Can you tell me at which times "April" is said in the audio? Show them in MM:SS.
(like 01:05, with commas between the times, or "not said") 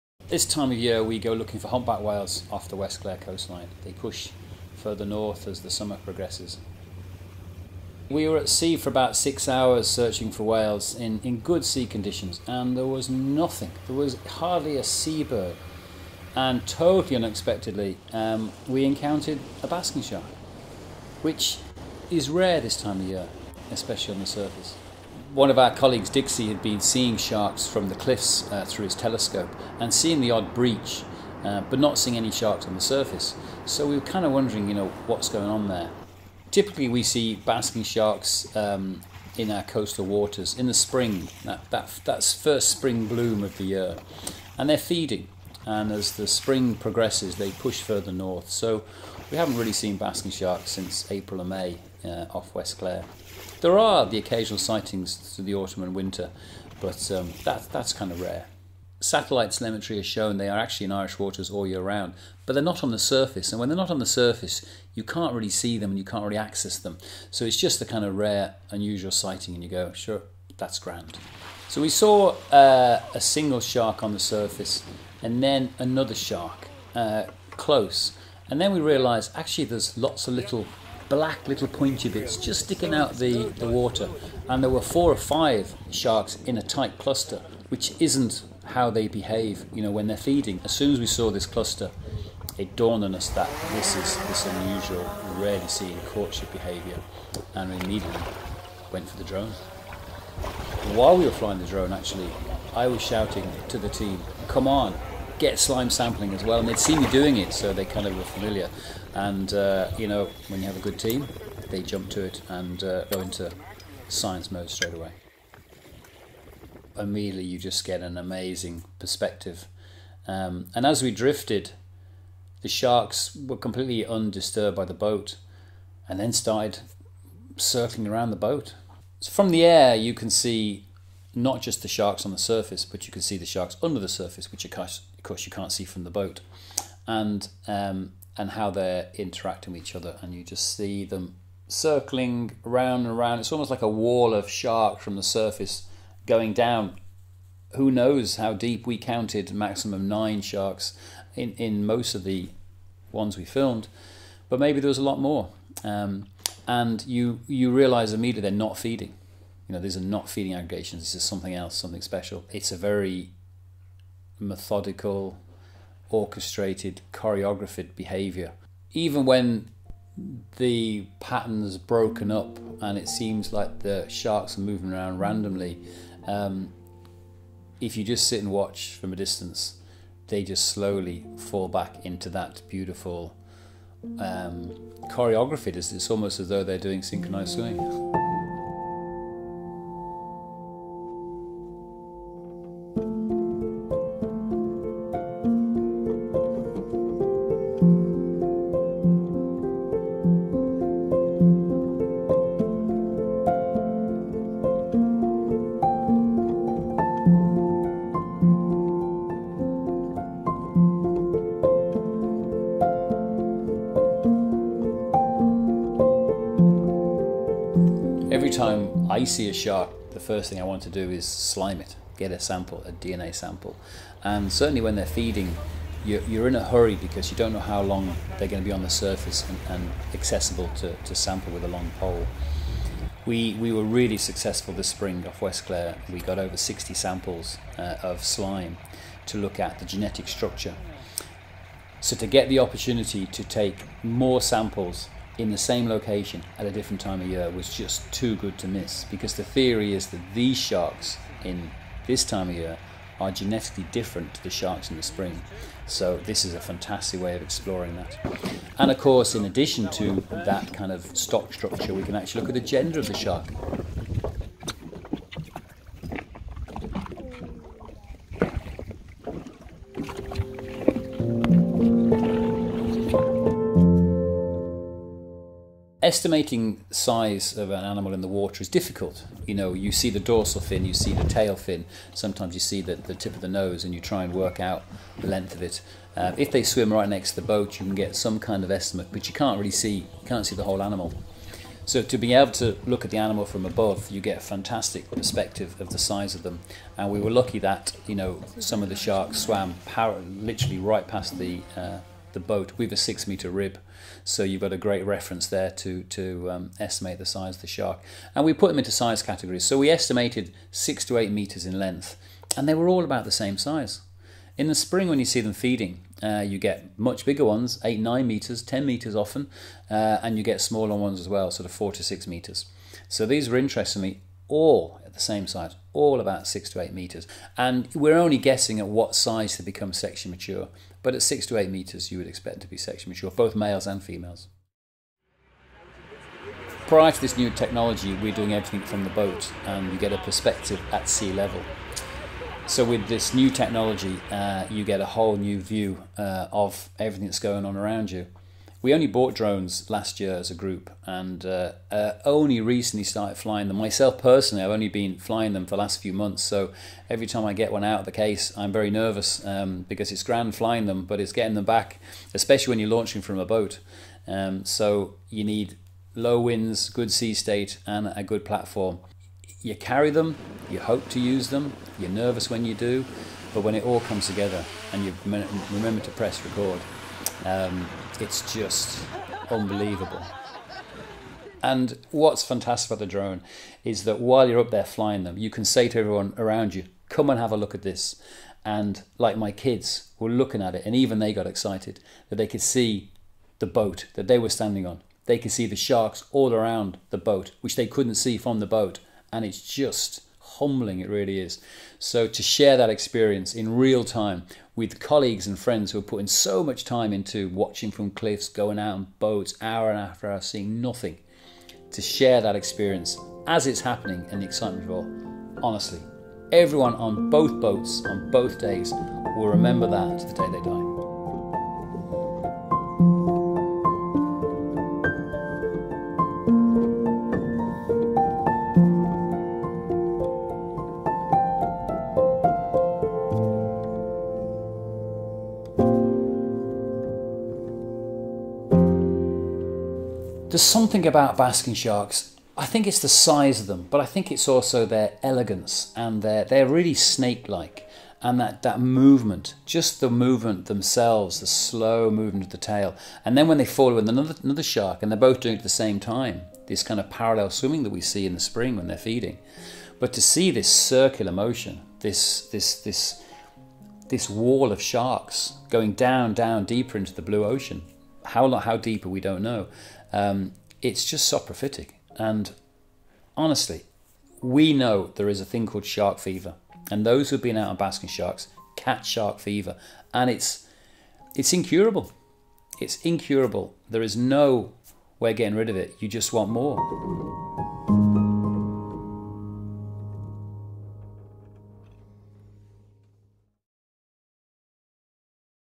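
00:51.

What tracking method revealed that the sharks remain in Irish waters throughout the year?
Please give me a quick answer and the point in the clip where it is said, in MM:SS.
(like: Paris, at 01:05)
Satellite telemetry, at 00:58.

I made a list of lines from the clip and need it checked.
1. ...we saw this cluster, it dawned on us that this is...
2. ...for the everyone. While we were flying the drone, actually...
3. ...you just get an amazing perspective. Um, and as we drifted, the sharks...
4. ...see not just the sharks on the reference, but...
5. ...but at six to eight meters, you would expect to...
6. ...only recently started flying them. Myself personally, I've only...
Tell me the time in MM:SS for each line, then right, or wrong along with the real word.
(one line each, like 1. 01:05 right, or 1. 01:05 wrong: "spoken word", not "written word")
1. 01:31 right
2. 01:39 wrong: "drone", not "everyone"
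3. 01:57 right
4. 02:10 wrong: "surface", not "reference"
5. 05:31 right
6. 05:52 right.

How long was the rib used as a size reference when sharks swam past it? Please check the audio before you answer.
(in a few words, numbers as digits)
6 meters.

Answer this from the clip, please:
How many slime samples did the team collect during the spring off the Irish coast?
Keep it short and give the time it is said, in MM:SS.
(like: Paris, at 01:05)
Over 60, at 03:56.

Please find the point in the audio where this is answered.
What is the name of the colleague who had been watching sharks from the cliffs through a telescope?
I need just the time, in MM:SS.
00:26.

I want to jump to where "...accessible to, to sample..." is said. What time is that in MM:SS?
03:50.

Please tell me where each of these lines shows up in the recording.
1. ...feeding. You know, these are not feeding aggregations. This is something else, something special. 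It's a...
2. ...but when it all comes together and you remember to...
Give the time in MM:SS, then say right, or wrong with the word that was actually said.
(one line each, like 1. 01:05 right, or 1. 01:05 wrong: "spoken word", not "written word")
1. 02:38 right
2. 06:13 right.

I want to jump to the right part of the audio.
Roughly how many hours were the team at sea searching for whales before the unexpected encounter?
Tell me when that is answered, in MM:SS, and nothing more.
00:09.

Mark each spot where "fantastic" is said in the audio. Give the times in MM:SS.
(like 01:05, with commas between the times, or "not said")
04:16, 04:54, 06:22.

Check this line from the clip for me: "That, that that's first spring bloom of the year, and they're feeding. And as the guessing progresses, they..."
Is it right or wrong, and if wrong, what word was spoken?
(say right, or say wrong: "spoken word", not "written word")
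wrong: "spring", not "guessing".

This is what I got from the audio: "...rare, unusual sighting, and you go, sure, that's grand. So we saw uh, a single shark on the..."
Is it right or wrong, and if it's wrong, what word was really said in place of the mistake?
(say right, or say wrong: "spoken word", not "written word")
right.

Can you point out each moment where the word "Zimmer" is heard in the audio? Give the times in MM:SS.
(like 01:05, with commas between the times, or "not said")
not said.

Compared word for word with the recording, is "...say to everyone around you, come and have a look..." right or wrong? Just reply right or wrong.
right.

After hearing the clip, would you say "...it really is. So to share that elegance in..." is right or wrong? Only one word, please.
wrong.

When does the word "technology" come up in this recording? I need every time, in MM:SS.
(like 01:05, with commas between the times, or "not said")
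05:37, 05:43.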